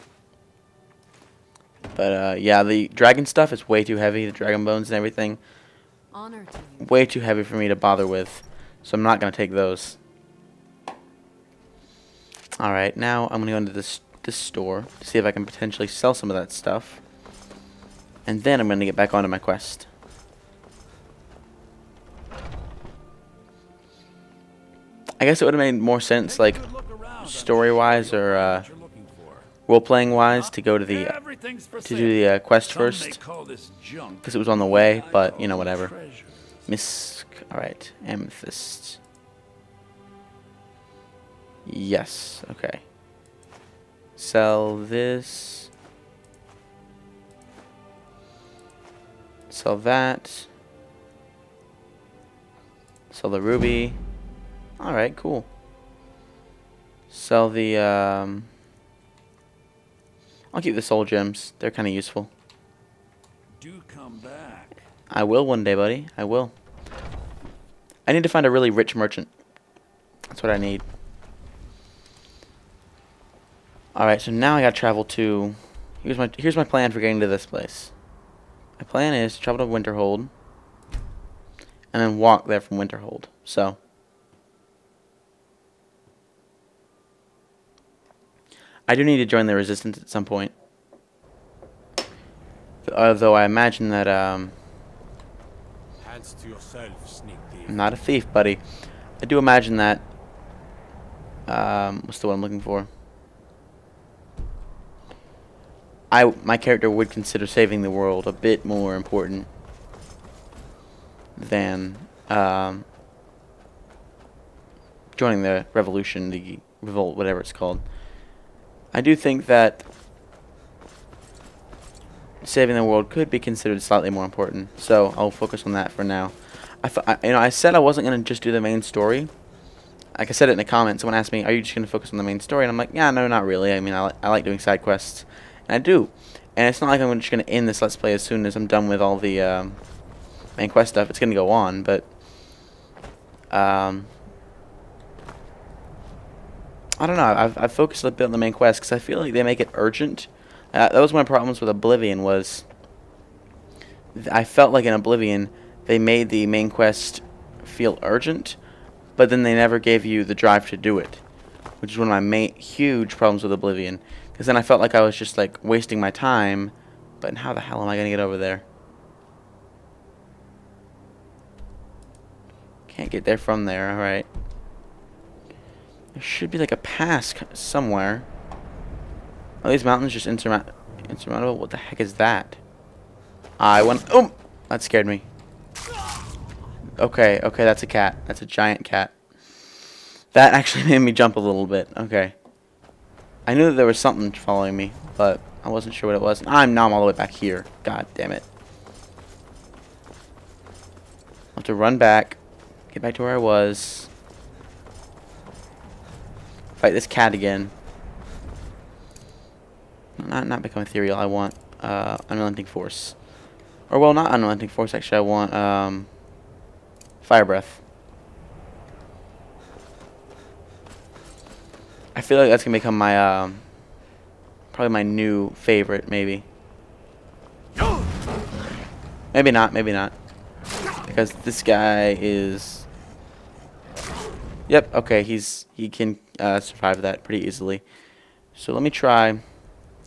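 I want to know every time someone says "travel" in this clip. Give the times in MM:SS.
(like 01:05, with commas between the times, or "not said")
01:14, 01:19.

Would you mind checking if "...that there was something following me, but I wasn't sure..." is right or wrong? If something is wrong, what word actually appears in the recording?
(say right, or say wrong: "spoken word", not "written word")
right.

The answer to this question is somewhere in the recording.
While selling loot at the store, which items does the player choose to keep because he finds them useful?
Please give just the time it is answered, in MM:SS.
01:00.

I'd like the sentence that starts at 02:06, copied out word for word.
I, you know, I said I wasn't going to just do the main story.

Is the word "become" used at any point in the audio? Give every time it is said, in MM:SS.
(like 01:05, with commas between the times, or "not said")
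03:30, 03:42.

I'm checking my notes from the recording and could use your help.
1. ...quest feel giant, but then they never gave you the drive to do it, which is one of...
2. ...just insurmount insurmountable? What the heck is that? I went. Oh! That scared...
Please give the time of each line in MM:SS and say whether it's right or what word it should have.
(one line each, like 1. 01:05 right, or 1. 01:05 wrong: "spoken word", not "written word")
1. 02:36 wrong: "urgent", not "giant"
2. 03:00 right.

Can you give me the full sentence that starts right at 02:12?
And I'm like, yeah, no, not really.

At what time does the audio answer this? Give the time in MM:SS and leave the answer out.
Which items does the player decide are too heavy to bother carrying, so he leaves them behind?
00:04.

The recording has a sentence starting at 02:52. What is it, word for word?
Can't get there from there, alright.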